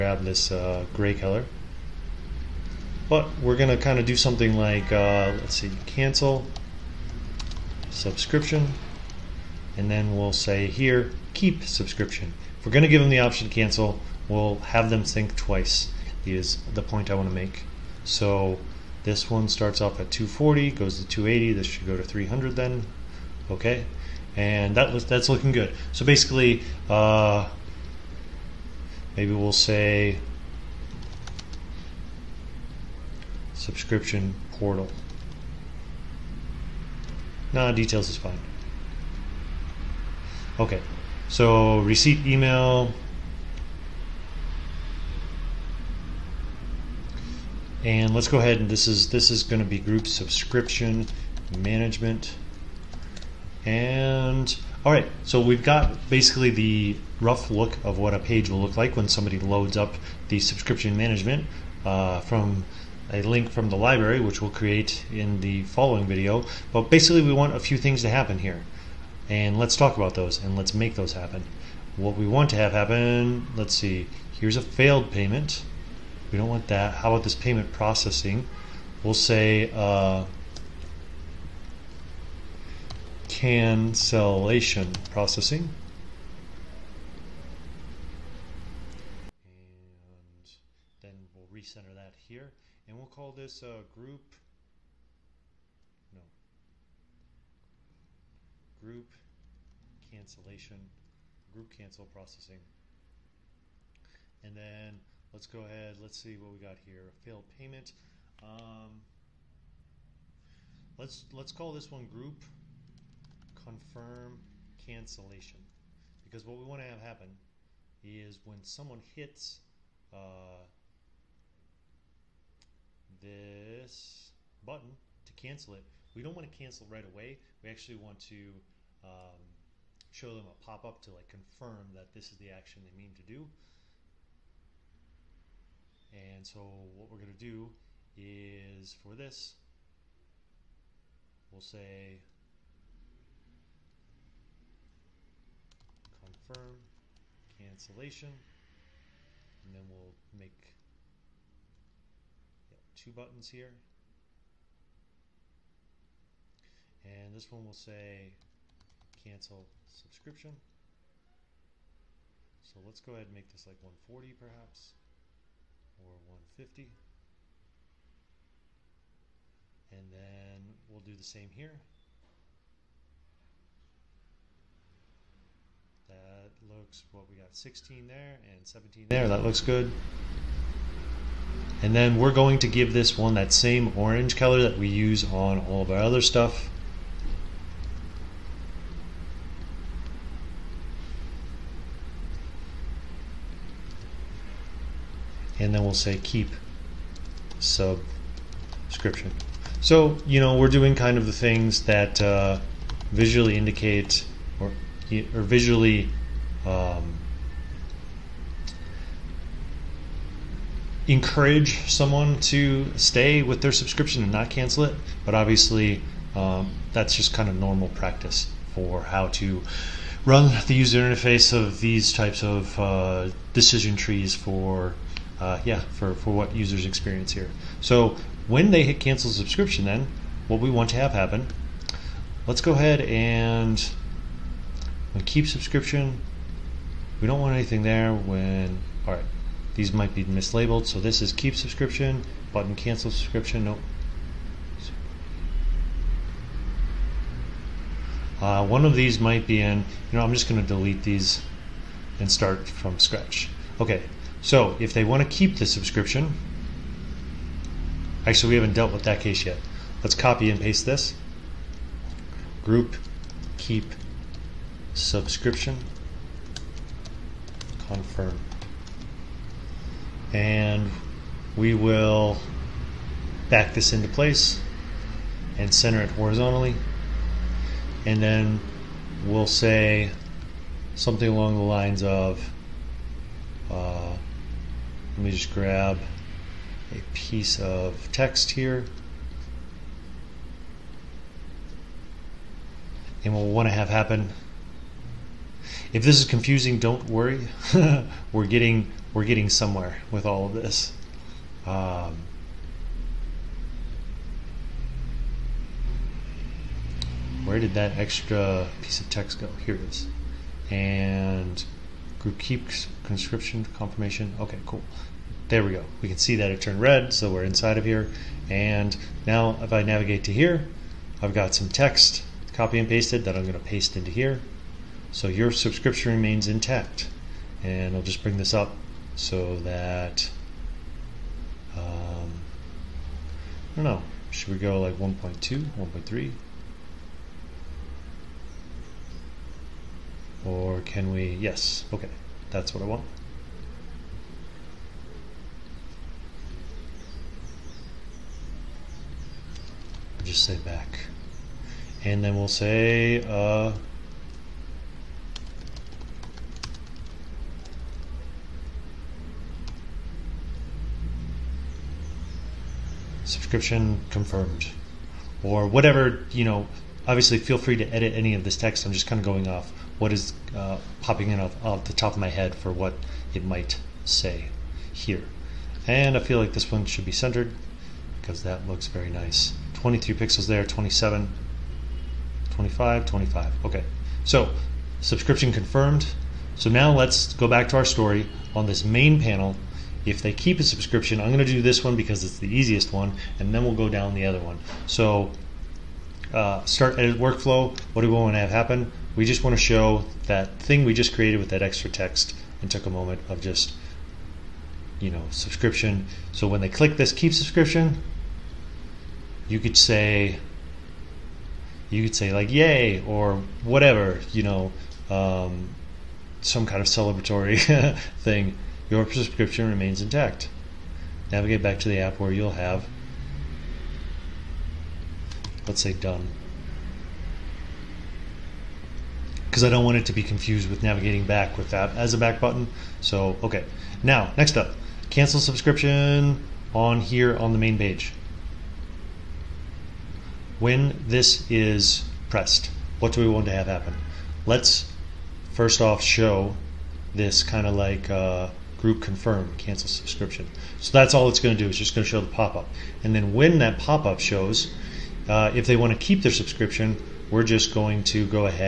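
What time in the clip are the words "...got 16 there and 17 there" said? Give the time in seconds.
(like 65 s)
177 s.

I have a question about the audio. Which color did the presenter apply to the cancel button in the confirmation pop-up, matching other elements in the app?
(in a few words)
orange.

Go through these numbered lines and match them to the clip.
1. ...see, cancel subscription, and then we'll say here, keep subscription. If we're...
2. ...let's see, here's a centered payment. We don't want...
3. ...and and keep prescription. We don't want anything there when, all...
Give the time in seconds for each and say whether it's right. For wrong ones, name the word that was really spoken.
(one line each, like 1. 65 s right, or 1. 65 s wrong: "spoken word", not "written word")
1. 5 s right
2. 73 s wrong: "failed", not "centered"
3. 233 s wrong: "subscription", not "prescription".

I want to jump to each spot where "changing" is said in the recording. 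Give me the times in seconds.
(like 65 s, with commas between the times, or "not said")
not said.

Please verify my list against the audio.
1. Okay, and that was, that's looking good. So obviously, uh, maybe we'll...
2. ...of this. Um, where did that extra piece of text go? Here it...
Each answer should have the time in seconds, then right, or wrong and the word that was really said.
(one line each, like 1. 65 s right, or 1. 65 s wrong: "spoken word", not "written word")
1. 23 s wrong: "basically", not "obviously"
2. 300 s right.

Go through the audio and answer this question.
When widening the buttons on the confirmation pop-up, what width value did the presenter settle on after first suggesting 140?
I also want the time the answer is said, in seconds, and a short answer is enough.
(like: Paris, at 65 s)
150, at 166 s.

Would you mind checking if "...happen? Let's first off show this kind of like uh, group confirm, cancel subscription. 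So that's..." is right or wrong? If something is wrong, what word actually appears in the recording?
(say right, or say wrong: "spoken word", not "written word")
right.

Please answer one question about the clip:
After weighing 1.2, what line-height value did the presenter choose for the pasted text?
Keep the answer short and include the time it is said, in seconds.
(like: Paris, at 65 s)
1.3, at 335 s.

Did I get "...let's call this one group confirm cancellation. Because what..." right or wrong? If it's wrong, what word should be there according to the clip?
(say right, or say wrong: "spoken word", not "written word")
right.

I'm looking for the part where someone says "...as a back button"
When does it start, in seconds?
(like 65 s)
431 s.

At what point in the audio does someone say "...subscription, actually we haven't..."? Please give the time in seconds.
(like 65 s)
255 s.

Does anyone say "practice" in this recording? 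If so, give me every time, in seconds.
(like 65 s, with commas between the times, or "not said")
217 s.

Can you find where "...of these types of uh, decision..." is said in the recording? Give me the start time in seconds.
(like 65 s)
221 s.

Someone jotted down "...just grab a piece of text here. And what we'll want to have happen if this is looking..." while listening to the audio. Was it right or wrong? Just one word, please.
wrong.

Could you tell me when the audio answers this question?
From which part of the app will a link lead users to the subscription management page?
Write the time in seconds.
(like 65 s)
63 s.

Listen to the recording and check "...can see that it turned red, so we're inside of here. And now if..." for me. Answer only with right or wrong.
right.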